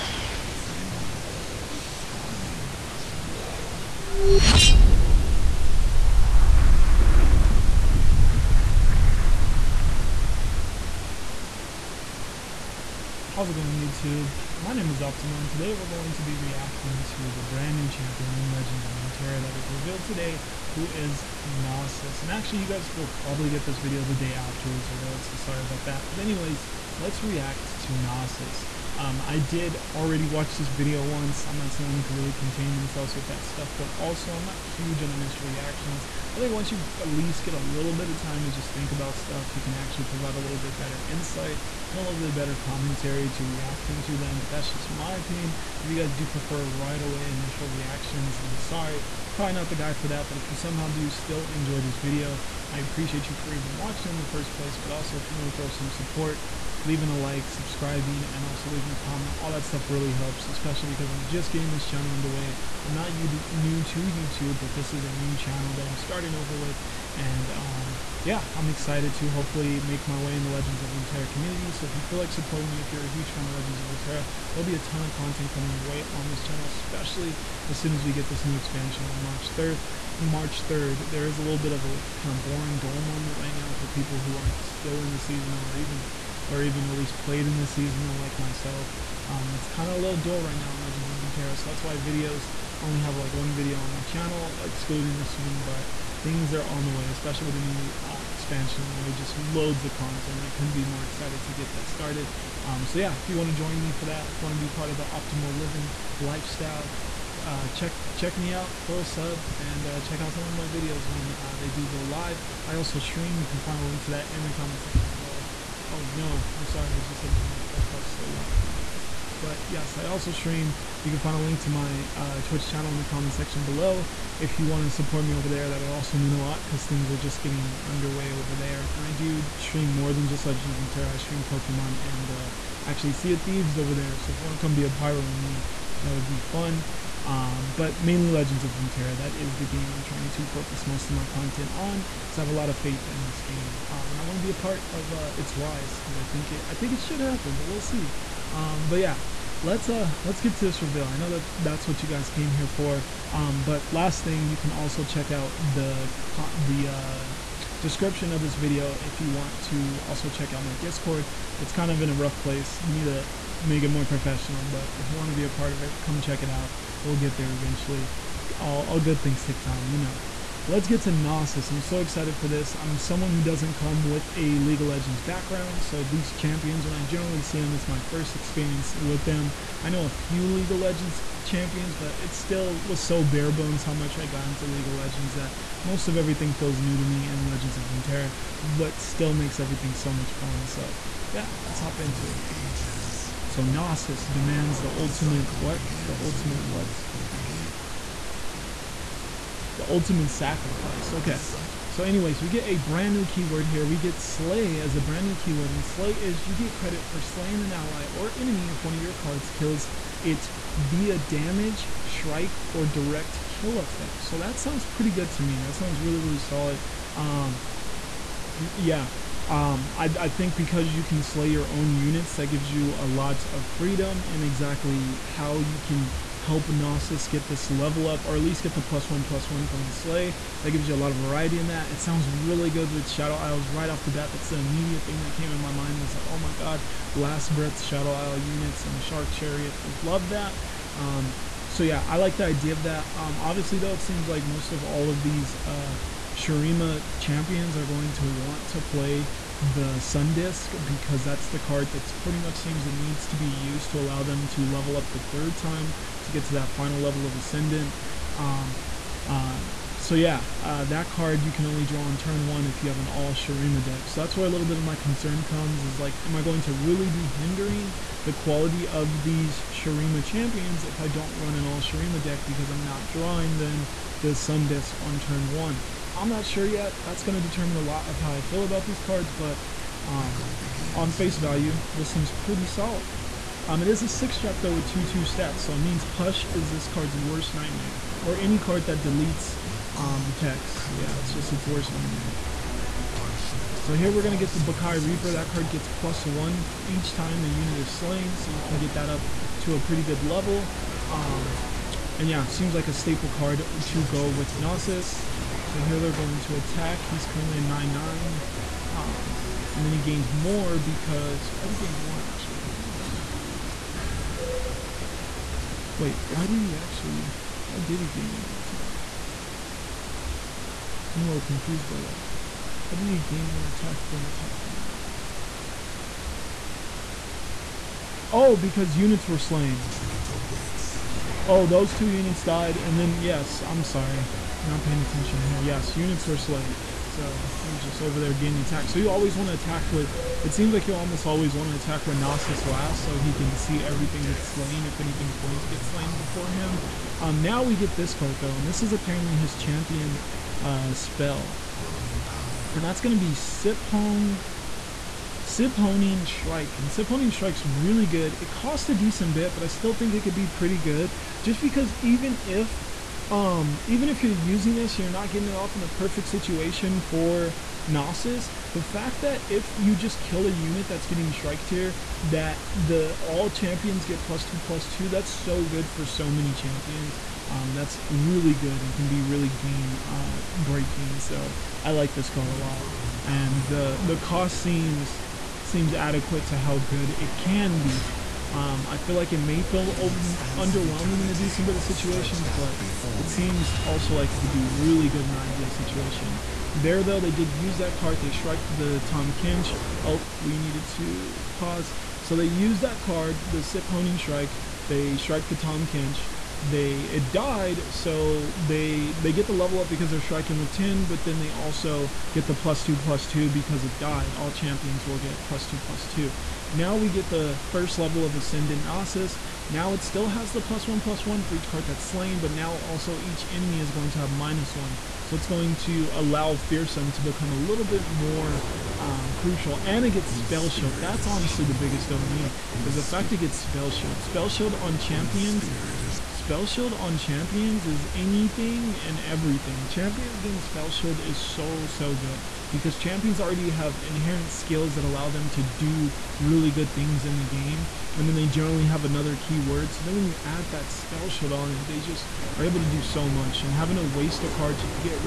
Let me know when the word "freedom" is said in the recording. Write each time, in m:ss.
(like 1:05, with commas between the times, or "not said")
3:43.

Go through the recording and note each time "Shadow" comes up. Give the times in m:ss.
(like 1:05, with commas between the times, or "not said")
3:53, 3:57.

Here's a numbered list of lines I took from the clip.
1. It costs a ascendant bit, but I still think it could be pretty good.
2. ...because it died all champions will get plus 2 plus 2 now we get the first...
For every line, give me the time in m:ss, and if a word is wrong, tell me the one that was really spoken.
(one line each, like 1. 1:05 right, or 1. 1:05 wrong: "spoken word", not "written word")
1. 5:58 wrong: "decent", not "ascendant"
2. 6:53 right.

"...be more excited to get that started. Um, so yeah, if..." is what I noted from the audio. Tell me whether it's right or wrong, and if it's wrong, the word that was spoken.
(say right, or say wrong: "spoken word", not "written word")
right.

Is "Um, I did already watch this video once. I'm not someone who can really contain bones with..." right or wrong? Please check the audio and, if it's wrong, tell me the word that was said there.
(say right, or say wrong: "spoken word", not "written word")
wrong: "themselves", not "bones".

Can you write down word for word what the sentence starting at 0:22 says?
And actually you guys will probably get this video the day after it was revealed so sorry about that.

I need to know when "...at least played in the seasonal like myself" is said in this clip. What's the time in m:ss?
1:26.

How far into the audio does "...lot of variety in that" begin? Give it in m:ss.
3:50.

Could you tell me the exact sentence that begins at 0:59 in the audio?
All that stuff really helps, especially because I'm just getting this channel underway.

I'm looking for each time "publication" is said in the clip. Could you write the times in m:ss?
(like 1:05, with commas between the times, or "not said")
not said.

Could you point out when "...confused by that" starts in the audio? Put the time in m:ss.
5:21.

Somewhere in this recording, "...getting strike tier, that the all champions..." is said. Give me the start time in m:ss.
6:11.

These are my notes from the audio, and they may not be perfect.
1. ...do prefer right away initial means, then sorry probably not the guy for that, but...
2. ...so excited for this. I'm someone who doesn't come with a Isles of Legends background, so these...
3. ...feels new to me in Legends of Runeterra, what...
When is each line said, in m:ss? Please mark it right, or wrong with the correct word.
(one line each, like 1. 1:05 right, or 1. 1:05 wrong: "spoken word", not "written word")
1. 0:46 wrong: "reactions", not "means"
2. 2:51 wrong: "League", not "Isles"
3. 3:06 right.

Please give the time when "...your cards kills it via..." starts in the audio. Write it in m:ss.
3:28.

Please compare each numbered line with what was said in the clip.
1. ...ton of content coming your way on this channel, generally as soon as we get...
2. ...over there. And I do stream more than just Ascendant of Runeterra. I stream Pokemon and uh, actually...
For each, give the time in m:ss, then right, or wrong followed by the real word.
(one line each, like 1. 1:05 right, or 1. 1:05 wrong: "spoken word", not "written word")
1. 1:14 wrong: "especially", not "generally"
2. 2:08 wrong: "Legend", not "Ascendant".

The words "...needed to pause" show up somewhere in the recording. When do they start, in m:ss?
6:40.